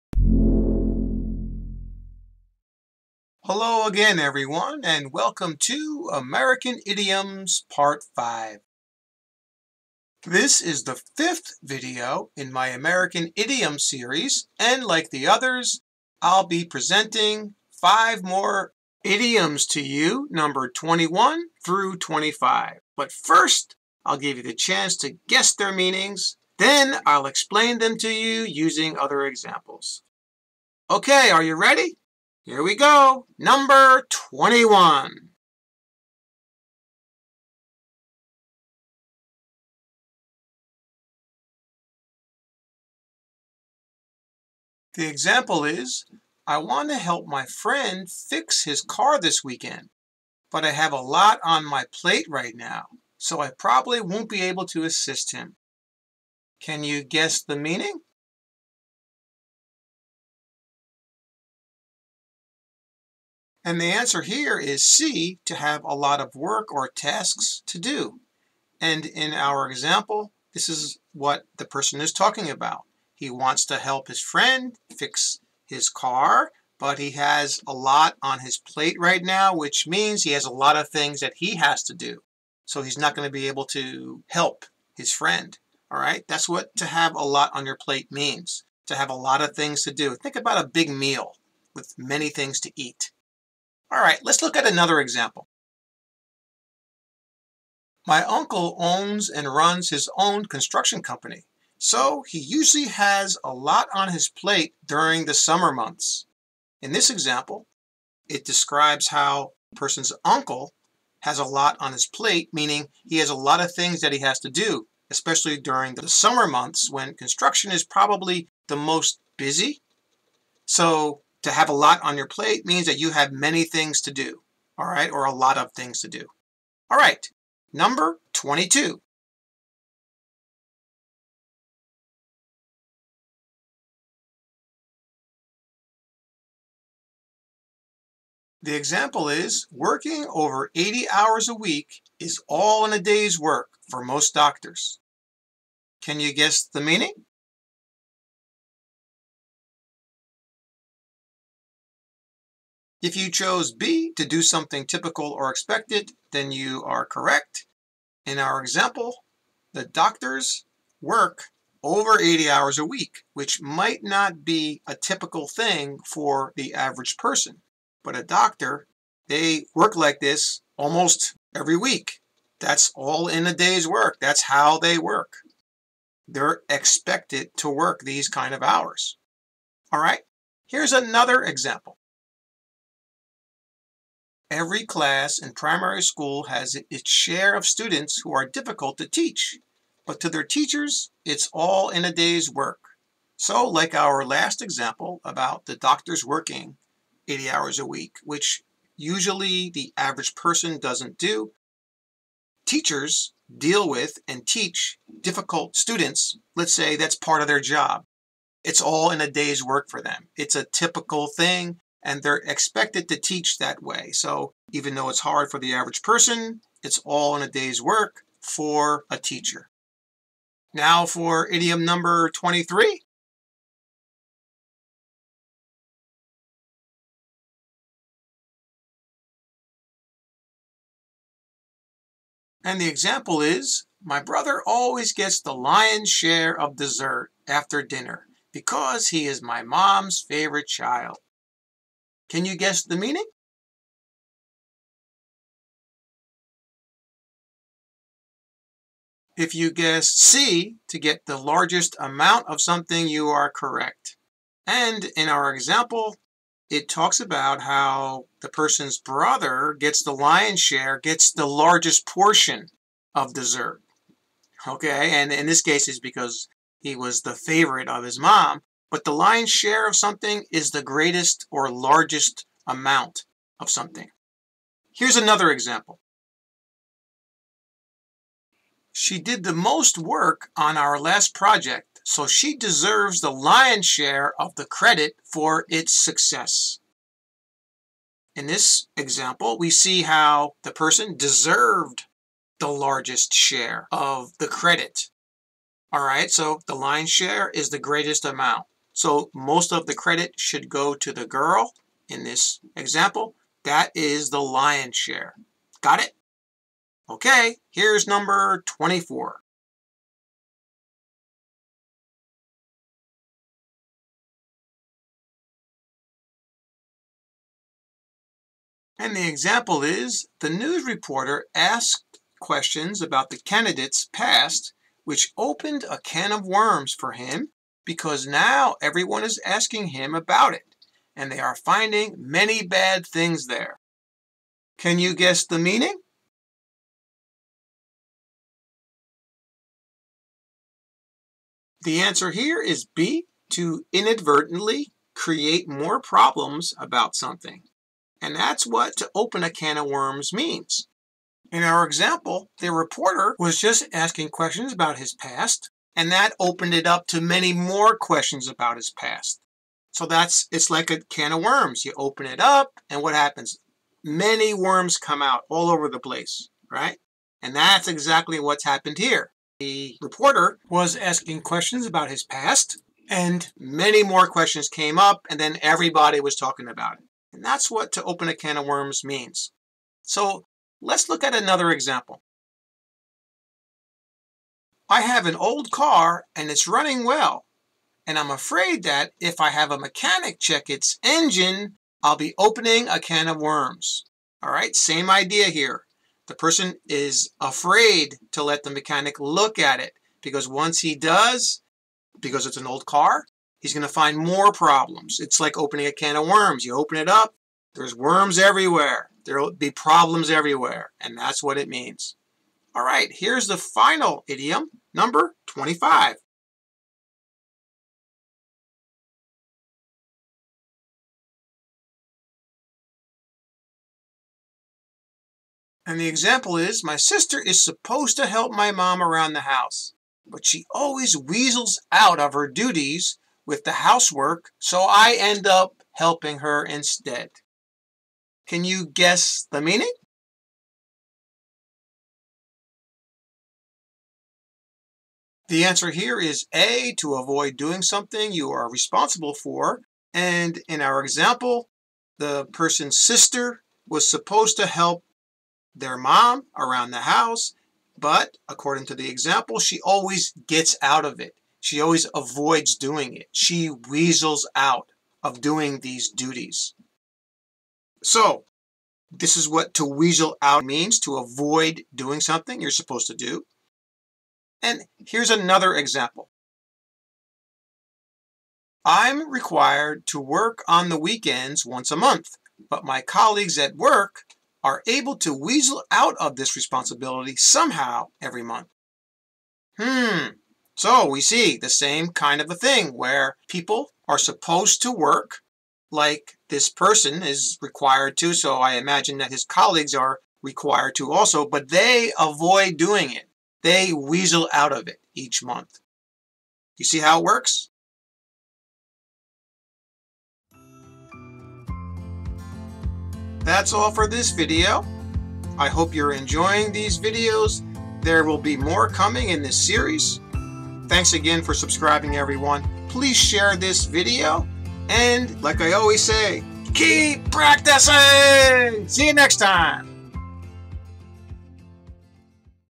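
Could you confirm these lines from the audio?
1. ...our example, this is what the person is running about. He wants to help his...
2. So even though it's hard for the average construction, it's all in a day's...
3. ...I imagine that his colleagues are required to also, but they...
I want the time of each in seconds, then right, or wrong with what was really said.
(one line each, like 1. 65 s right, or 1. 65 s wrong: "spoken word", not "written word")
1. 69 s wrong: "talking", not "running"
2. 214 s wrong: "person", not "construction"
3. 498 s right.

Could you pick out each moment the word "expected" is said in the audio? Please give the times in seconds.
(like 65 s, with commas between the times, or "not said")
155 s, 176 s, 212 s.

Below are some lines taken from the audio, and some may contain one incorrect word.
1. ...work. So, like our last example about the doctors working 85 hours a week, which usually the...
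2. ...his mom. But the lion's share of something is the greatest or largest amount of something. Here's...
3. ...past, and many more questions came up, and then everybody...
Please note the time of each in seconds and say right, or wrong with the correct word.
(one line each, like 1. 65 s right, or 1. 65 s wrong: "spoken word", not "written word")
1. 192 s wrong: "80", not "85"
2. 268 s right
3. 372 s right.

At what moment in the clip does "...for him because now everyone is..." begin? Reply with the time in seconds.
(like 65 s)
326 s.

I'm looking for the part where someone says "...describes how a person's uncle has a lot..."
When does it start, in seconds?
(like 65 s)
108 s.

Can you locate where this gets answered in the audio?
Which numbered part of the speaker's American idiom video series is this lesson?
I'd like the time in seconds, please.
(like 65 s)
7 s.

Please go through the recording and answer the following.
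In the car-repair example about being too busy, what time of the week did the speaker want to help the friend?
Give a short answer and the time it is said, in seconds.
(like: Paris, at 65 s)
this weekend, at 49 s.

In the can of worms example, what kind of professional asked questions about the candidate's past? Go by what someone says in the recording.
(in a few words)
news reporter.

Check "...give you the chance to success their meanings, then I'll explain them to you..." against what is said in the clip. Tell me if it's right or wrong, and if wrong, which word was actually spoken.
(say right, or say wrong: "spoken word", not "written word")
wrong: "guess", not "success".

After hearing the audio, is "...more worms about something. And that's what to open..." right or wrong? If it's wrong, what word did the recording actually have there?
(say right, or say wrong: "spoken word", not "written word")
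wrong: "problems", not "worms".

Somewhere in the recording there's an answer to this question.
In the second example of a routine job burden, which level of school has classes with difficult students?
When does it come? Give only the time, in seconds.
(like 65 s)
185 s.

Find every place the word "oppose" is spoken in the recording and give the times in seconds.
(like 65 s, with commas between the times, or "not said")
not said.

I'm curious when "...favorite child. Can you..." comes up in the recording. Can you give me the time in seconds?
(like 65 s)
240 s.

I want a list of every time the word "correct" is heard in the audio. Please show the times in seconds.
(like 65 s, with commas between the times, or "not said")
157 s, 253 s.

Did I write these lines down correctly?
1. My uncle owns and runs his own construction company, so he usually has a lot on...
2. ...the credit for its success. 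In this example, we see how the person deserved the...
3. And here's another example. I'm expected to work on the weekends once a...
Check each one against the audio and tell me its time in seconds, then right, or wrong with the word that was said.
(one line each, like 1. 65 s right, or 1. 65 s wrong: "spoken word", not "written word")
1. 98 s right
2. 284 s right
3. 474 s wrong: "required", not "expected".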